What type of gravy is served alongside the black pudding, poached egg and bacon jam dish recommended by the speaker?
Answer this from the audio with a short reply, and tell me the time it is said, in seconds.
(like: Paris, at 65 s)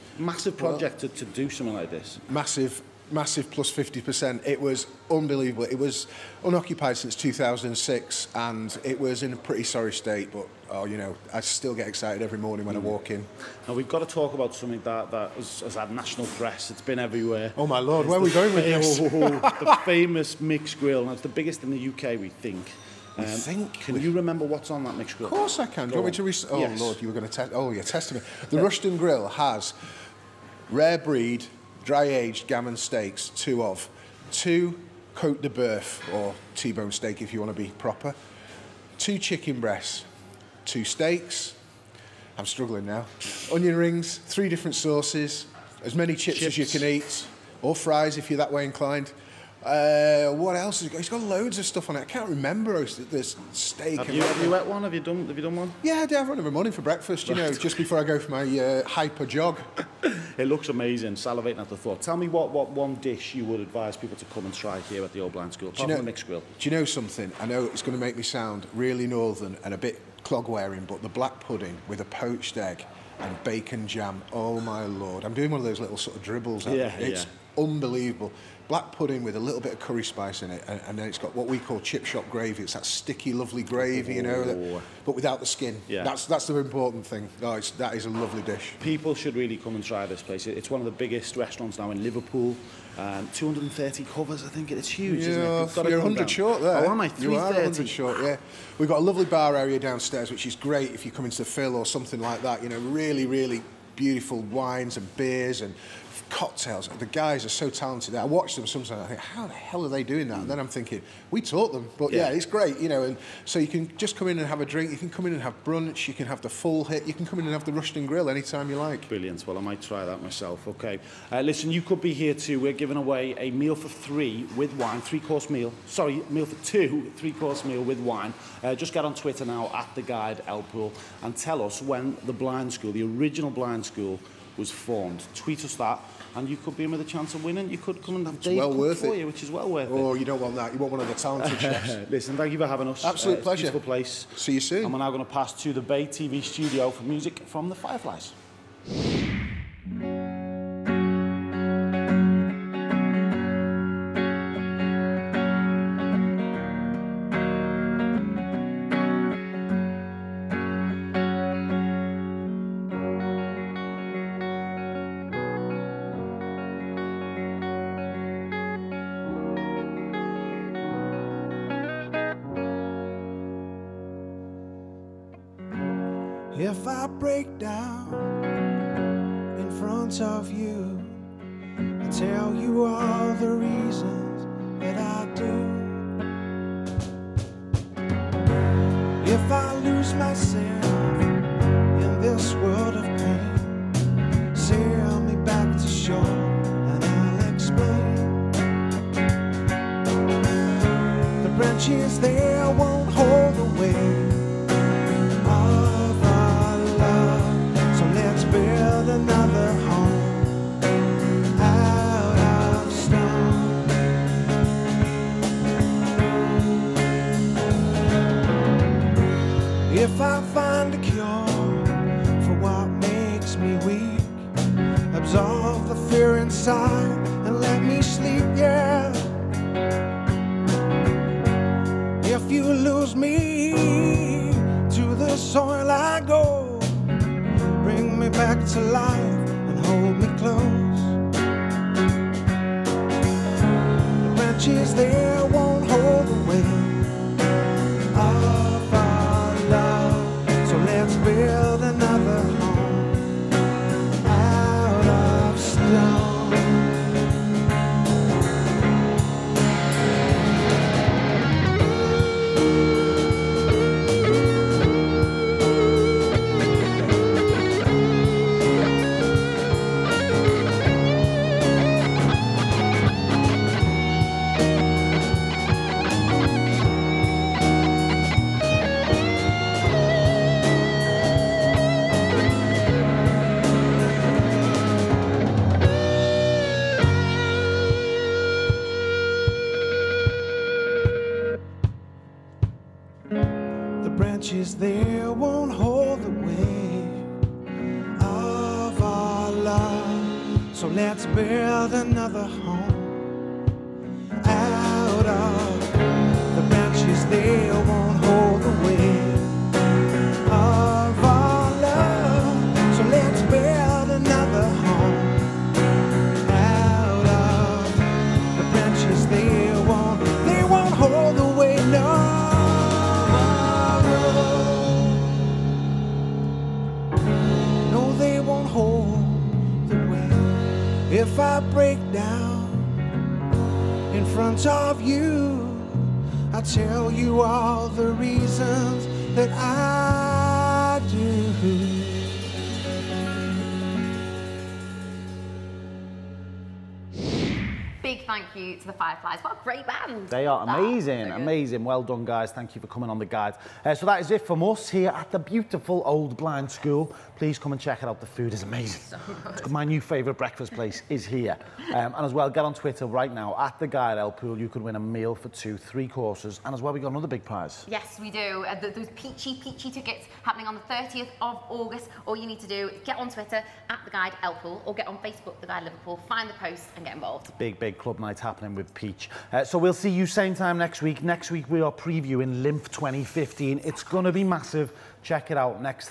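Chip shop gravy, at 81 s.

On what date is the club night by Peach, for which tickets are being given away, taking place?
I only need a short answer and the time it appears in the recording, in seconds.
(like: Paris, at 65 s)
30 August, at 370 s.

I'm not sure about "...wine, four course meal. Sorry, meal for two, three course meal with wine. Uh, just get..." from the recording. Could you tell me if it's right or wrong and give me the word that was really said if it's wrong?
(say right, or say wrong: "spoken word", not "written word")
wrong: "three", not "four".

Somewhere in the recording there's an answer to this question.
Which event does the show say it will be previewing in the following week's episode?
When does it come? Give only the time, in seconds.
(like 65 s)
382 s.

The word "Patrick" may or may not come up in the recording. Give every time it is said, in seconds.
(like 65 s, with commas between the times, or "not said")
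not said.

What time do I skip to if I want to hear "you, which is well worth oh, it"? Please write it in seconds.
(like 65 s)
139 s.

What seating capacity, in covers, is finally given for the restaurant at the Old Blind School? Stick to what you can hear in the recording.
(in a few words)
330.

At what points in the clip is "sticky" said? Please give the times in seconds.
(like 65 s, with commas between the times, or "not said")
82 s.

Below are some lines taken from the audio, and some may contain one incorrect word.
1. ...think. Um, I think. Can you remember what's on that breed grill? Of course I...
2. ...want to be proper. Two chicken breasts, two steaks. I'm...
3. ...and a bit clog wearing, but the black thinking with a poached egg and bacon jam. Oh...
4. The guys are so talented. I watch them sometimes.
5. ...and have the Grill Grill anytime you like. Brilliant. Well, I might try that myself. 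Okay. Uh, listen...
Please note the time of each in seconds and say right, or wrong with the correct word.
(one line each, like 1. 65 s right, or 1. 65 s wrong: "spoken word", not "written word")
1. 22 s wrong: "mixed", not "breed"
2. 37 s right
3. 69 s wrong: "pudding", not "thinking"
4. 106 s right
5. 117 s wrong: "Rushton", not "Grill".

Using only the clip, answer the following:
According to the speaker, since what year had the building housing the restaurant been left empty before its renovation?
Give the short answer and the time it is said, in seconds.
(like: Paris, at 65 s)
2006, at 7 s.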